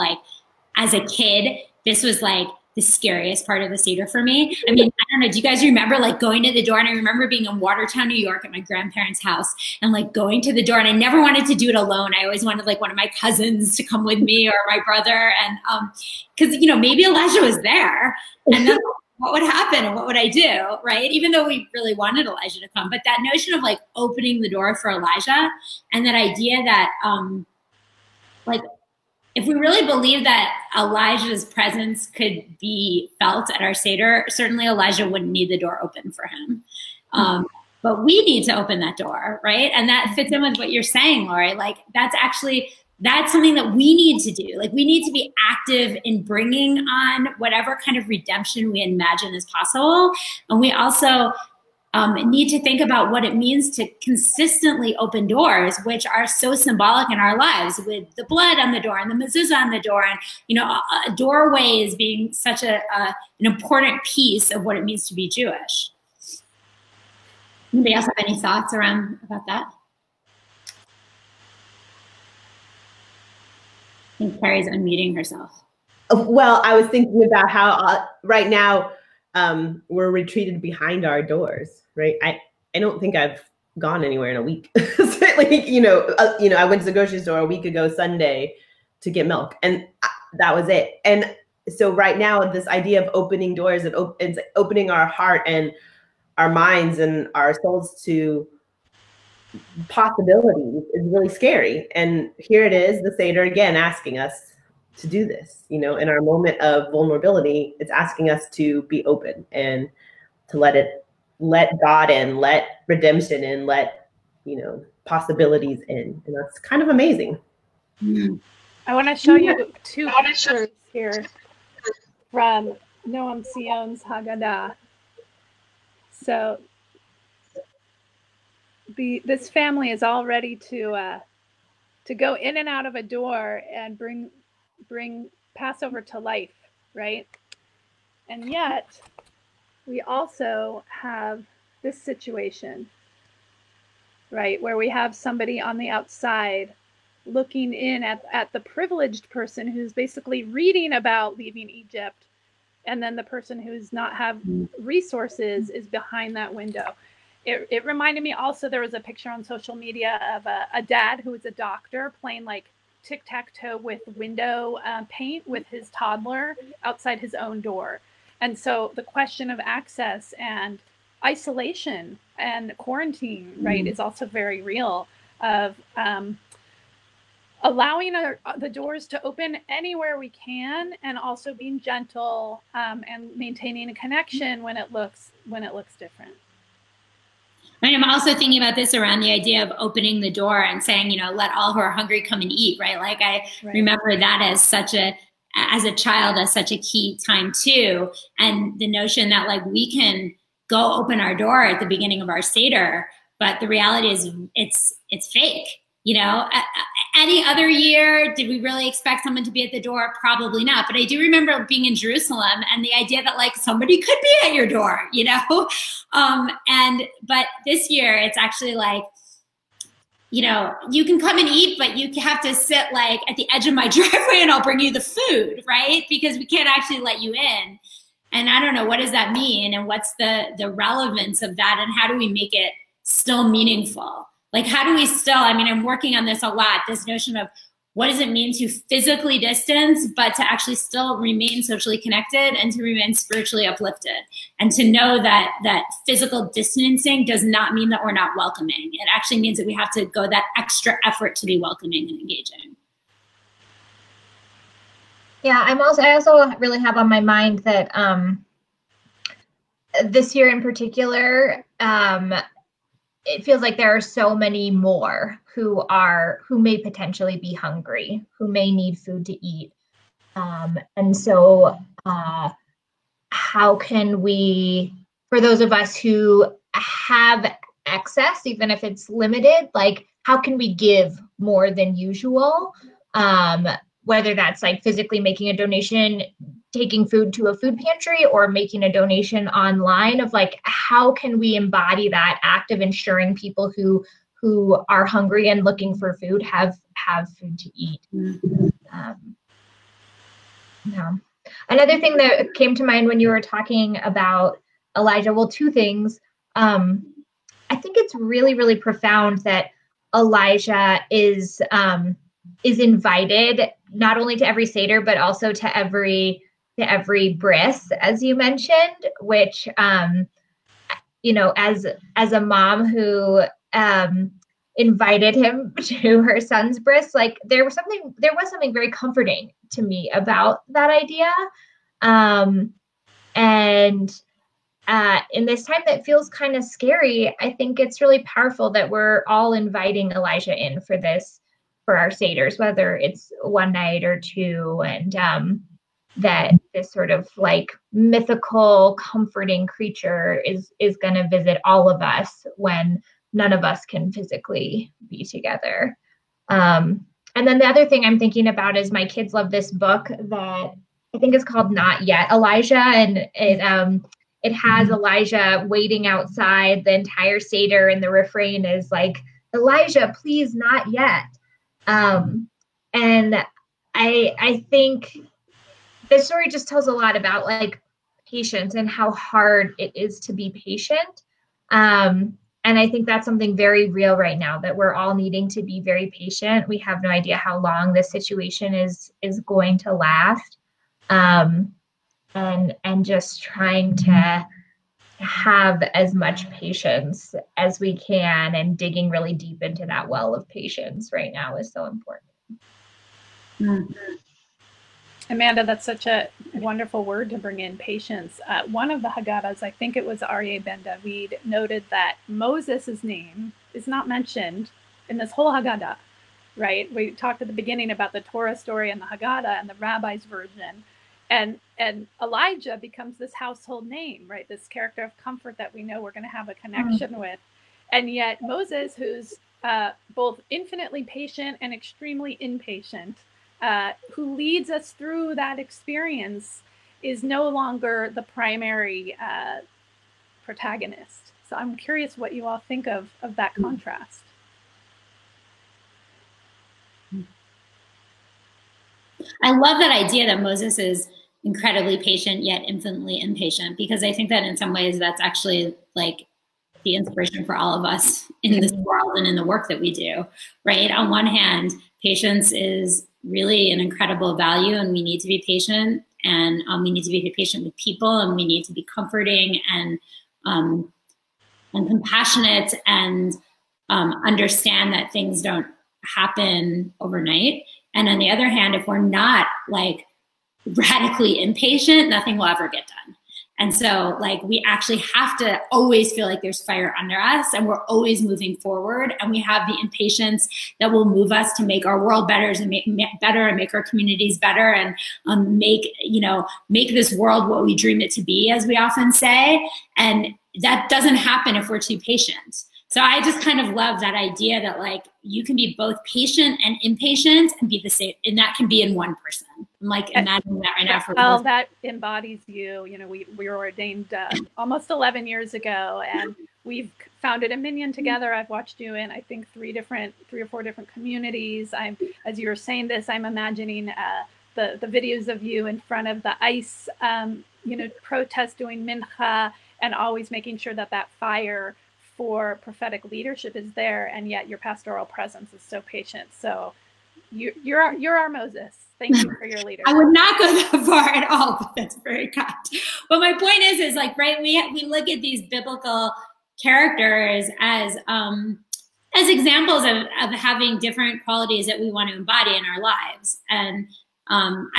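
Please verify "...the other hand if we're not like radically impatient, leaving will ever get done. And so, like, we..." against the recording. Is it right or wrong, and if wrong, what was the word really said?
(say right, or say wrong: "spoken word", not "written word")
wrong: "nothing", not "leaving".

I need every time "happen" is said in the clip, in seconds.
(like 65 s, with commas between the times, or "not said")
19 s, 476 s, 501 s.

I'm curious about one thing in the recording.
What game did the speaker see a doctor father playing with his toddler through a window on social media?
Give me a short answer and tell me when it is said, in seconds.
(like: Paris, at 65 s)
Tic tac toe, at 163 s.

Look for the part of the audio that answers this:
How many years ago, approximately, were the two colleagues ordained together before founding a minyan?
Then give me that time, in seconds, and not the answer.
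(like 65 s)
514 s.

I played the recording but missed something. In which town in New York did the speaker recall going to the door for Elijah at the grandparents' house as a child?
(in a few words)
Watertown.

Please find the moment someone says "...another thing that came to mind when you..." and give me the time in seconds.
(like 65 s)
301 s.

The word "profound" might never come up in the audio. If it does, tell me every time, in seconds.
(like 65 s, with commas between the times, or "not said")
308 s.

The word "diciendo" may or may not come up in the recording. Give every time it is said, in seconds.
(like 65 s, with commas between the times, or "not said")
not said.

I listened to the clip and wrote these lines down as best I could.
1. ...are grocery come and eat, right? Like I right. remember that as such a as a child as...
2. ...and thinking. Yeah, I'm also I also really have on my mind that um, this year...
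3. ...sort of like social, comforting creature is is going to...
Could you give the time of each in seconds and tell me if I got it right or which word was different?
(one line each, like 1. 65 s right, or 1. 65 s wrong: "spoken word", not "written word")
1. 191 s wrong: "hungry", not "grocery"
2. 252 s wrong: "engaging", not "thinking"
3. 346 s wrong: "mythical", not "social".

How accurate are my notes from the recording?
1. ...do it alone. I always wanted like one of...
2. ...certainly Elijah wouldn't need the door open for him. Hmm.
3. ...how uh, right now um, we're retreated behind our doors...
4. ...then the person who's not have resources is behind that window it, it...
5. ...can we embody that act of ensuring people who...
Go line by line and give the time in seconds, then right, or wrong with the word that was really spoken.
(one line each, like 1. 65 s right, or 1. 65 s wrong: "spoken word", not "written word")
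1. 11 s right
2. 34 s right
3. 77 s right
4. 153 s right
5. 291 s right.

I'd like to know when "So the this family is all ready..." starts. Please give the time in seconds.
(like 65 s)
126 s.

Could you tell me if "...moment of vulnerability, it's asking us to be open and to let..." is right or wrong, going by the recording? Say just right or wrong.
right.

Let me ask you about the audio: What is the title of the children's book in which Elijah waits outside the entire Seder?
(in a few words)
Not Yet Elijah.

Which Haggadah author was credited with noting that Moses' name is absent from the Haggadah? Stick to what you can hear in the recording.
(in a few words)
Aryeh Ben David.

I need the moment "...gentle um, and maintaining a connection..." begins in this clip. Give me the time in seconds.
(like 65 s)
181 s.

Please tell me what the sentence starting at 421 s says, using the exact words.
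And and Elijah becomes this household name, right?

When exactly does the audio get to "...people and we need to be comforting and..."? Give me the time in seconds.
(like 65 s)
467 s.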